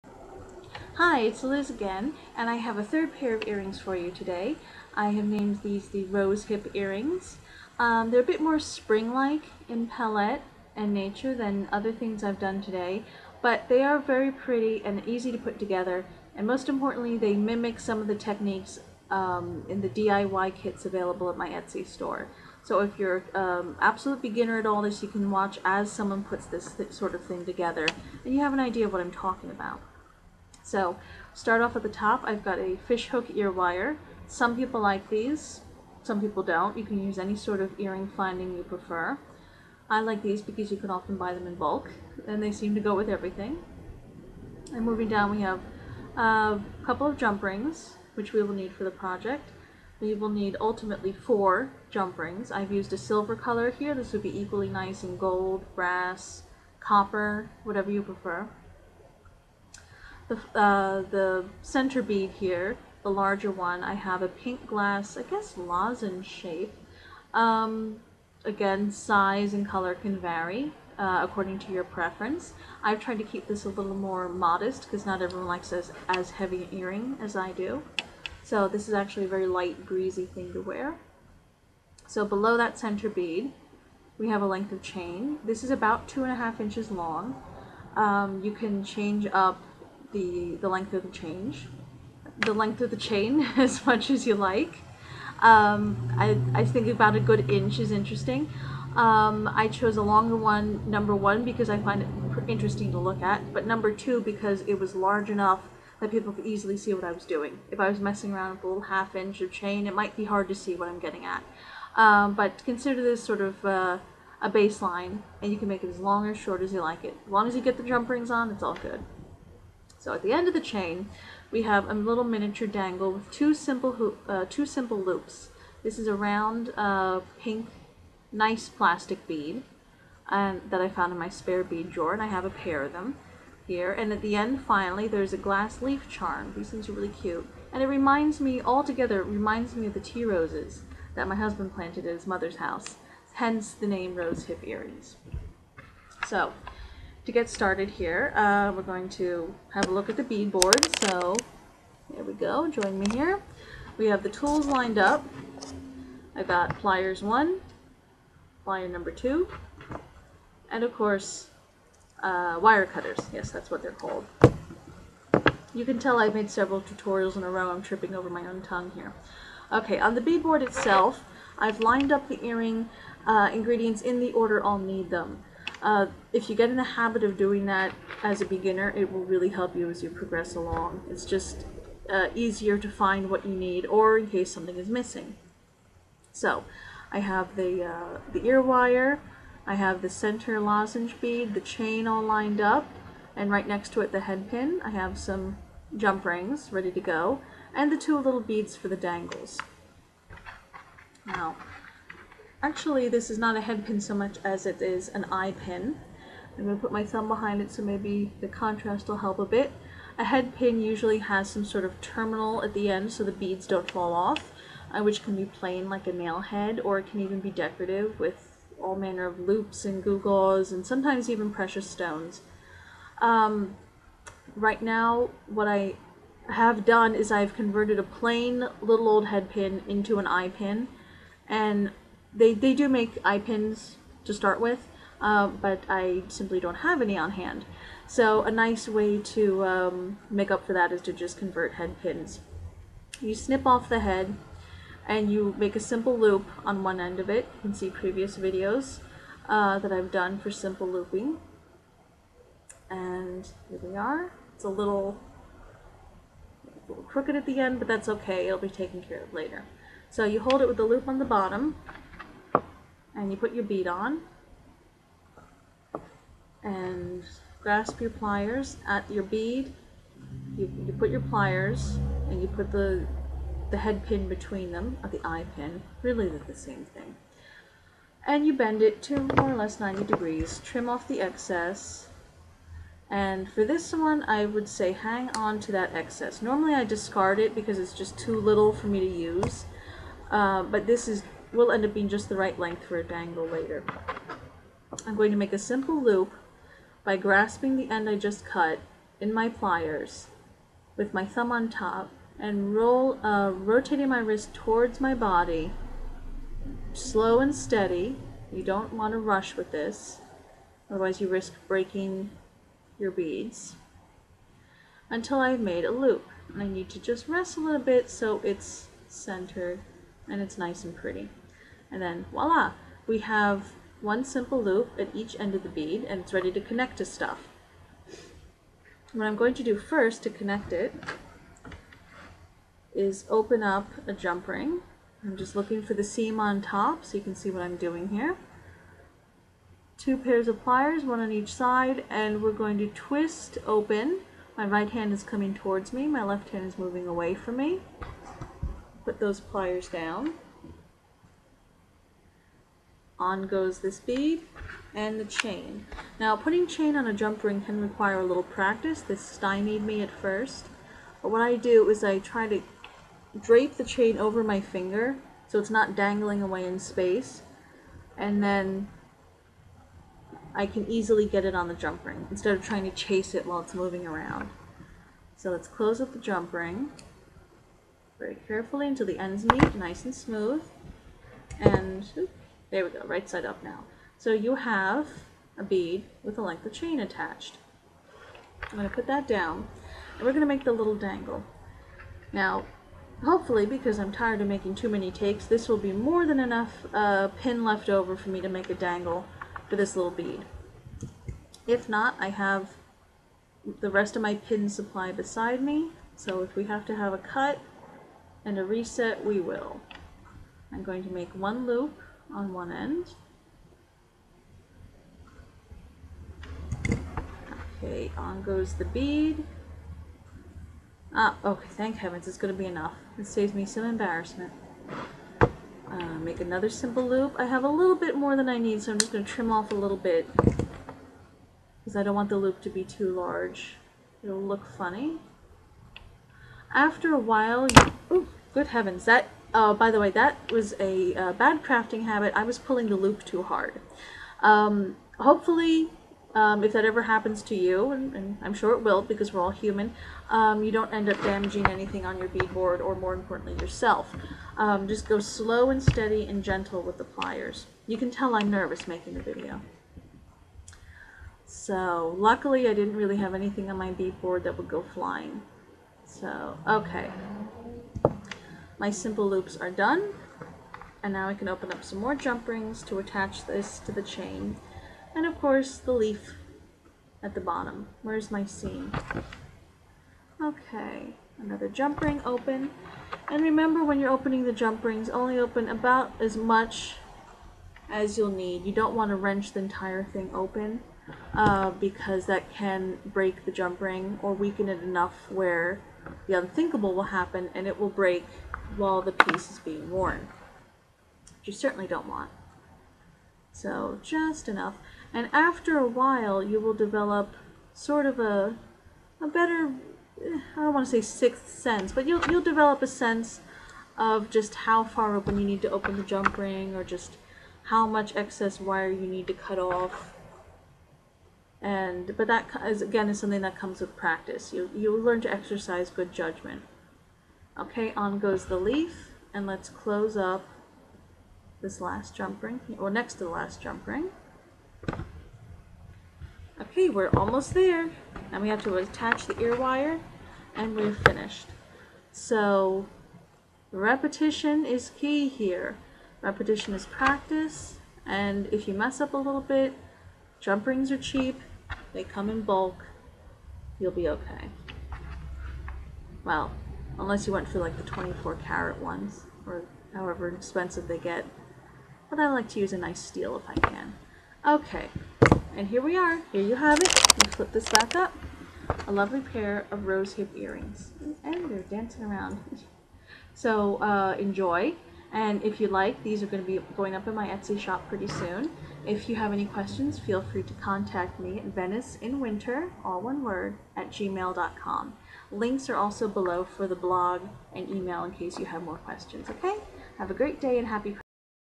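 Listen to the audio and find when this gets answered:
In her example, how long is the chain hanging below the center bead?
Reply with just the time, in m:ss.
1:26.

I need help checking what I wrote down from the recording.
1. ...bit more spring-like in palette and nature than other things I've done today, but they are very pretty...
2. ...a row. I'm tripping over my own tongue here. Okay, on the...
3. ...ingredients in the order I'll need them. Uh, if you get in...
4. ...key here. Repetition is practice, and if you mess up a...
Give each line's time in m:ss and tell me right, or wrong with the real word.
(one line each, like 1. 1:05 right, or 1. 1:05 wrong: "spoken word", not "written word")
1. 0:08 right
2. 2:47 right
3. 2:53 right
4. 9:04 right.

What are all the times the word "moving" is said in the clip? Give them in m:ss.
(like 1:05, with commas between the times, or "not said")
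0:44, 5:46, 6:13.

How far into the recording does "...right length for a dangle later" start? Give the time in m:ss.
4:52.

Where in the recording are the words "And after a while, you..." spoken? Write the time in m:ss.
8:25.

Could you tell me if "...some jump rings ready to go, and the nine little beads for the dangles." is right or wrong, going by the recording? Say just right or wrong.
wrong.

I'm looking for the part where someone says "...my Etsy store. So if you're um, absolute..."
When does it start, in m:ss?
0:21.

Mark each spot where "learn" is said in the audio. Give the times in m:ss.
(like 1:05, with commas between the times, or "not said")
8:44.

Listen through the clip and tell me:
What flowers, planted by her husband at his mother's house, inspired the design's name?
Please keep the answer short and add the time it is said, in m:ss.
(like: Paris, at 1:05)
tea roses, at 2:19.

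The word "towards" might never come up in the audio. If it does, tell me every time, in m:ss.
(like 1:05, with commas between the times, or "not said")
5:04, 5:45.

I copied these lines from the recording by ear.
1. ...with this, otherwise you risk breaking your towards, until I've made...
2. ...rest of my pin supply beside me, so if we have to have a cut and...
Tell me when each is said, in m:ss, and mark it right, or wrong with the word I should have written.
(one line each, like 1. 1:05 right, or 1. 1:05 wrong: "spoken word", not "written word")
1. 5:09 wrong: "beads", not "towards"
2. 6:43 right.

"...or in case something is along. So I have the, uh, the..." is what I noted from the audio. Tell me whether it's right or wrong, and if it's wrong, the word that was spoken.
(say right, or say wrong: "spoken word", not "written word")
wrong: "missing", not "along".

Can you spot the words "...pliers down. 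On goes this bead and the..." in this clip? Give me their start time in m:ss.
5:49.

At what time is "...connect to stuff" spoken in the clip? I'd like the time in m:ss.
5:26.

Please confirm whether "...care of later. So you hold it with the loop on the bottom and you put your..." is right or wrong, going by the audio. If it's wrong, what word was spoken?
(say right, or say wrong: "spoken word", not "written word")
right.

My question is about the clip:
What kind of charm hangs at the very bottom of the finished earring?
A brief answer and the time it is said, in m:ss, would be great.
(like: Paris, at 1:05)
glass leaf charm, at 2:15.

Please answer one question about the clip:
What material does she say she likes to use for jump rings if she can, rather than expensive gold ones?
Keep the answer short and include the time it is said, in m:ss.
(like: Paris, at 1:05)
steel, at 9:22.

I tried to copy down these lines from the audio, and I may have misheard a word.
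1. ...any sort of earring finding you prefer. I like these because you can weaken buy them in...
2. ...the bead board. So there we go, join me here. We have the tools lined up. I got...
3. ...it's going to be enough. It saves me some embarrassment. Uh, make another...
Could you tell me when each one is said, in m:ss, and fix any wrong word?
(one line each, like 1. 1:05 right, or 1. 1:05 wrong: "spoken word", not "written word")
1. 0:37 wrong: "often", not "weaken"
2. 2:30 right
3. 7:02 right.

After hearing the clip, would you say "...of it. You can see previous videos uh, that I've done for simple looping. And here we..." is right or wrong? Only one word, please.
right.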